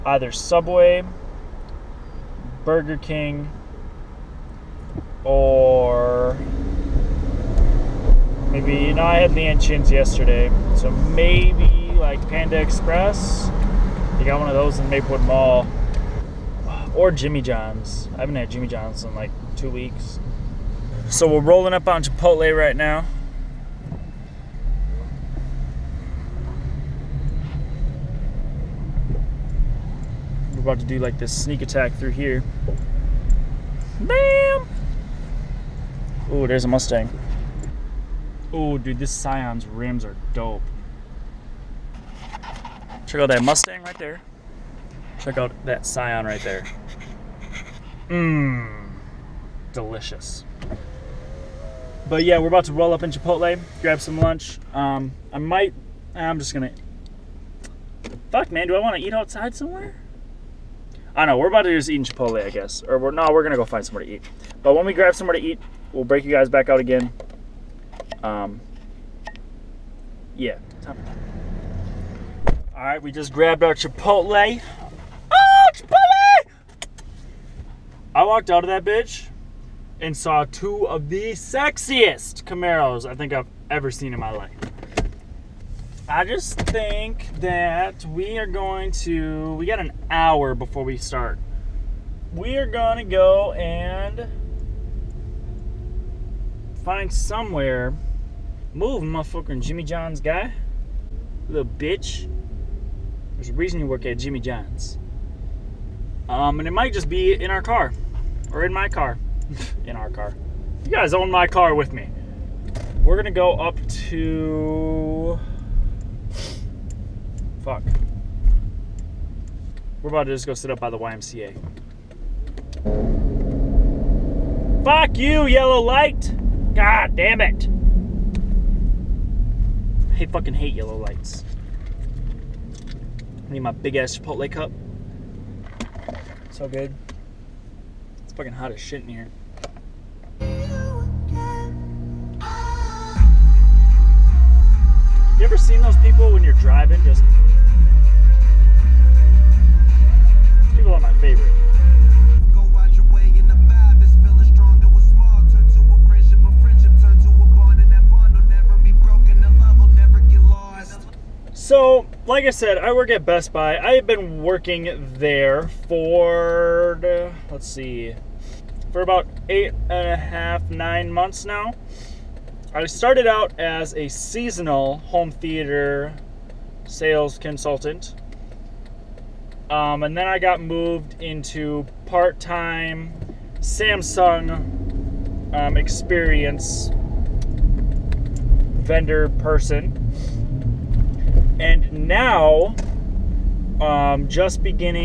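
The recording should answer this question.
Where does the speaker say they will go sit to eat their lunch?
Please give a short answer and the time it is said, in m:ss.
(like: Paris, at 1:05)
YMCA, at 2:00.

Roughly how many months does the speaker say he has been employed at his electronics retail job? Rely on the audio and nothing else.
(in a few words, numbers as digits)
8 and a half to 9 months.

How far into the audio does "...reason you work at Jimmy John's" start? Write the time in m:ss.
1:43.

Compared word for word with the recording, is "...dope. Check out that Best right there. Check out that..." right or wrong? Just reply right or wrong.
wrong.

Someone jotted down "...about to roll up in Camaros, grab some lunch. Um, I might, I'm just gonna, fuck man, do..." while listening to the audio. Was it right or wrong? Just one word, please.
wrong.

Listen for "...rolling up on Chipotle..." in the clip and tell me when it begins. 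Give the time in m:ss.
0:21.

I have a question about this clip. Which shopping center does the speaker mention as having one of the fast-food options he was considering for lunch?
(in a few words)
Maplewood Mall.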